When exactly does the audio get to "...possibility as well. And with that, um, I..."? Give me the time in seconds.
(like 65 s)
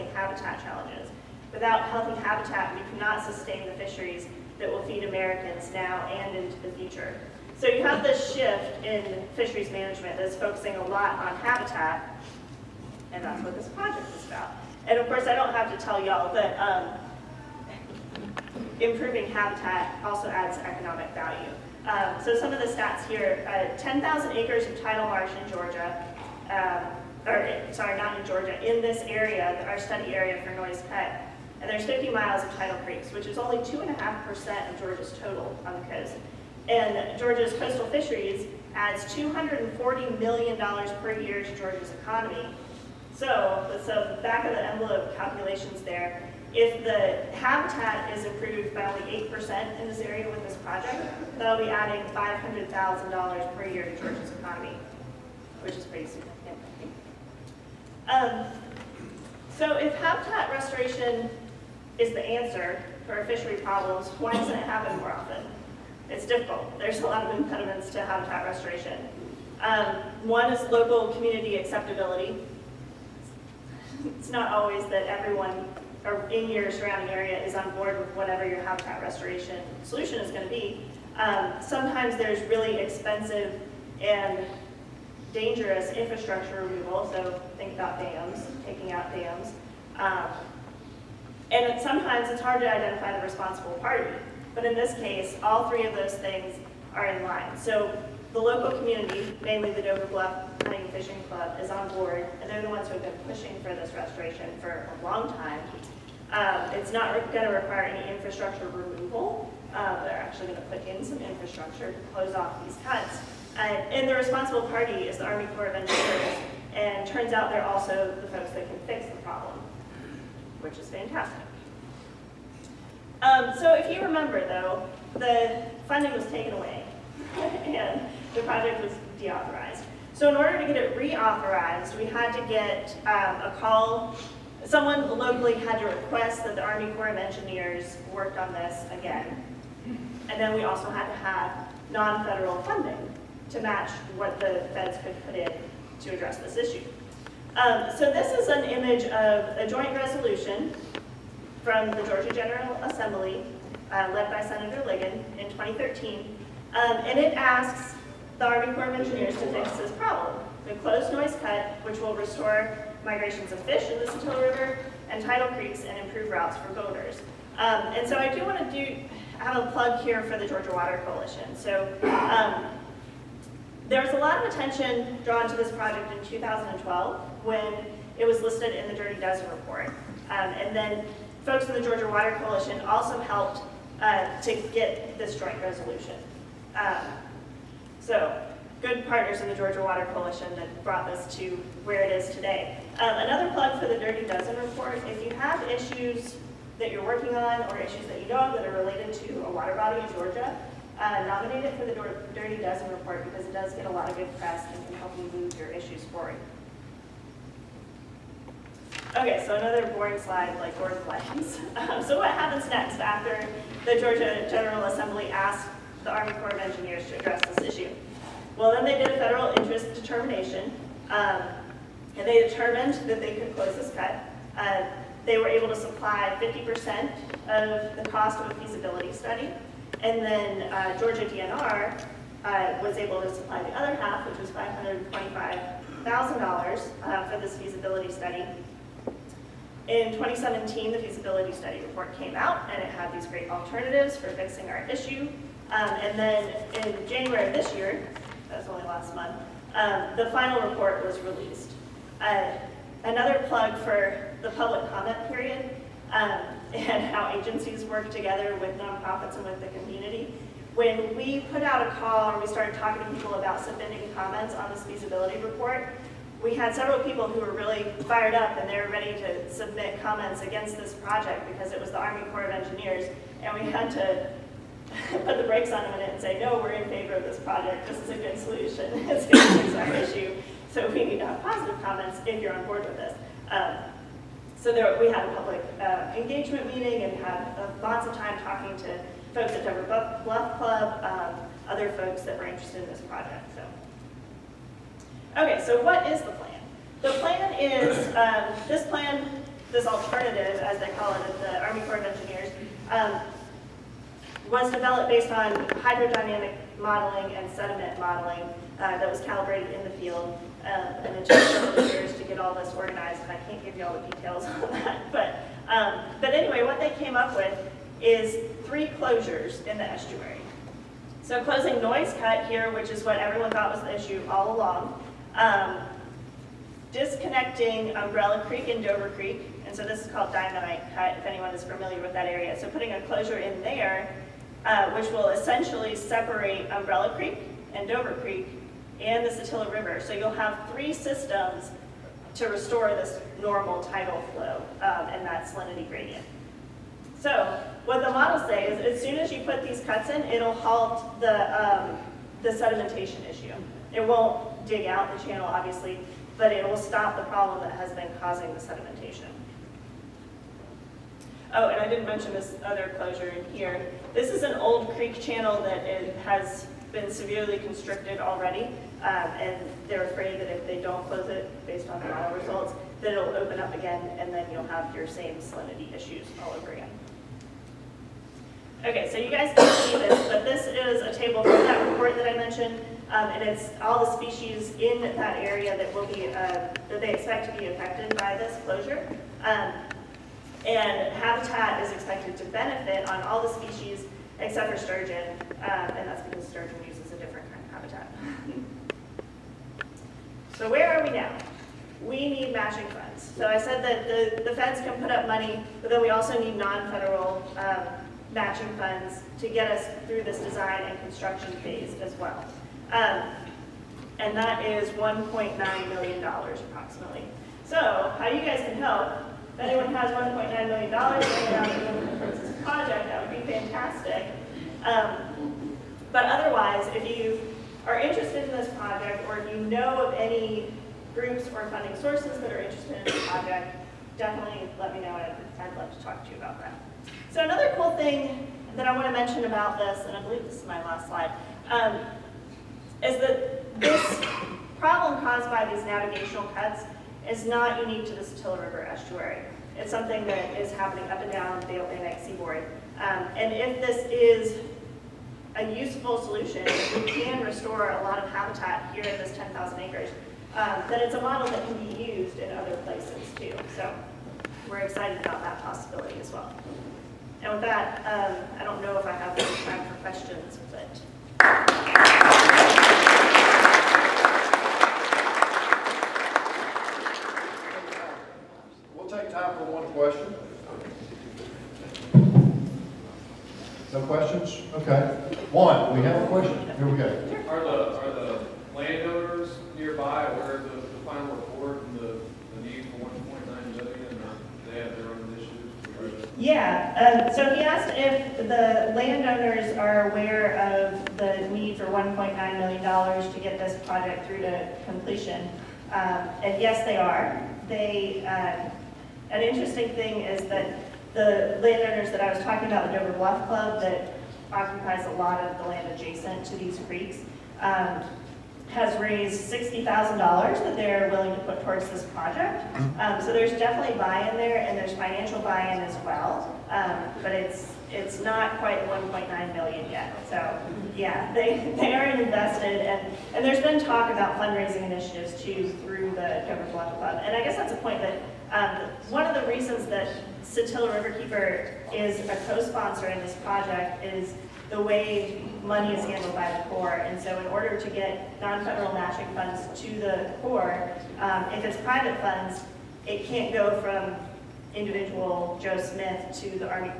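465 s.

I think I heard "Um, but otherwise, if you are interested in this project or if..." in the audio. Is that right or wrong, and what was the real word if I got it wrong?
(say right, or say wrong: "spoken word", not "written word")
right.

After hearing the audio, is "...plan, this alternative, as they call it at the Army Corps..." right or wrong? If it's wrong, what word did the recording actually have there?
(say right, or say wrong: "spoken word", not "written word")
right.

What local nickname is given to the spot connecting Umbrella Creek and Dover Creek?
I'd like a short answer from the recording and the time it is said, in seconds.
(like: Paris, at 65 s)
dynamite cut, at 330 s.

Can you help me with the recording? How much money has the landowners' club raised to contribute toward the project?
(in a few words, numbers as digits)
$60,000.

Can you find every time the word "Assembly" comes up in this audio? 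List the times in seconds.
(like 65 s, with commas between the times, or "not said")
152 s, 214 s.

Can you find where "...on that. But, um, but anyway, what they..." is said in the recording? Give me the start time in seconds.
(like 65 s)
314 s.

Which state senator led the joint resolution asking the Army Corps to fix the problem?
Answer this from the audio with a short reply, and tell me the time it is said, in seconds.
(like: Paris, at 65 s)
Senator Ligon, at 154 s.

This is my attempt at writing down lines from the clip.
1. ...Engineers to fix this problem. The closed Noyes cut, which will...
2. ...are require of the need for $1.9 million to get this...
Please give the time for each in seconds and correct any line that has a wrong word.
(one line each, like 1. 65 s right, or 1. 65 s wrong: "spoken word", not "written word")
1. 158 s right
2. 499 s wrong: "aware", not "require".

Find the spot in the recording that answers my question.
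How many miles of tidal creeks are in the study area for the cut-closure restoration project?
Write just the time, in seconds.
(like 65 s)
31 s.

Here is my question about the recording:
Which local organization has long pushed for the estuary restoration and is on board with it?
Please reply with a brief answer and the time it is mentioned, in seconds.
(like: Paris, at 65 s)
Dover Bluff Hunting and Fishing Club, at 99 s.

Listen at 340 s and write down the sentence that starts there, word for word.
So you'll have three systems to restore this normal tidal flow um, and that salinity gradient.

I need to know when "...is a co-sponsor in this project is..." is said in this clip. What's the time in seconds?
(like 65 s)
541 s.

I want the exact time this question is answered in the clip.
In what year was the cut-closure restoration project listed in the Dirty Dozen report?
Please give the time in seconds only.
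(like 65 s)
176 s.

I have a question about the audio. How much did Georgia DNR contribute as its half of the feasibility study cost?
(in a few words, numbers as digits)
$525,000.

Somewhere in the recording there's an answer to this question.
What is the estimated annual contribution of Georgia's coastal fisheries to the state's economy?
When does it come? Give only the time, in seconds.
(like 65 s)
39 s.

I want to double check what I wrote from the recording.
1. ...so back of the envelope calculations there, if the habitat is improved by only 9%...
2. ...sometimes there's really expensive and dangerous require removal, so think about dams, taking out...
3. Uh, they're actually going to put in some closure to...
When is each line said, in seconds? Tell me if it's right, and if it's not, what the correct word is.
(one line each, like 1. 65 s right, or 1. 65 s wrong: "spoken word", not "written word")
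1. 43 s wrong: "8", not "9"
2. 81 s wrong: "infrastructure", not "require"
3. 109 s wrong: "infrastructure", not "closure".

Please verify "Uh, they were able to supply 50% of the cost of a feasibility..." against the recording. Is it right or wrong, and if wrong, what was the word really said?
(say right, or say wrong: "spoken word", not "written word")
right.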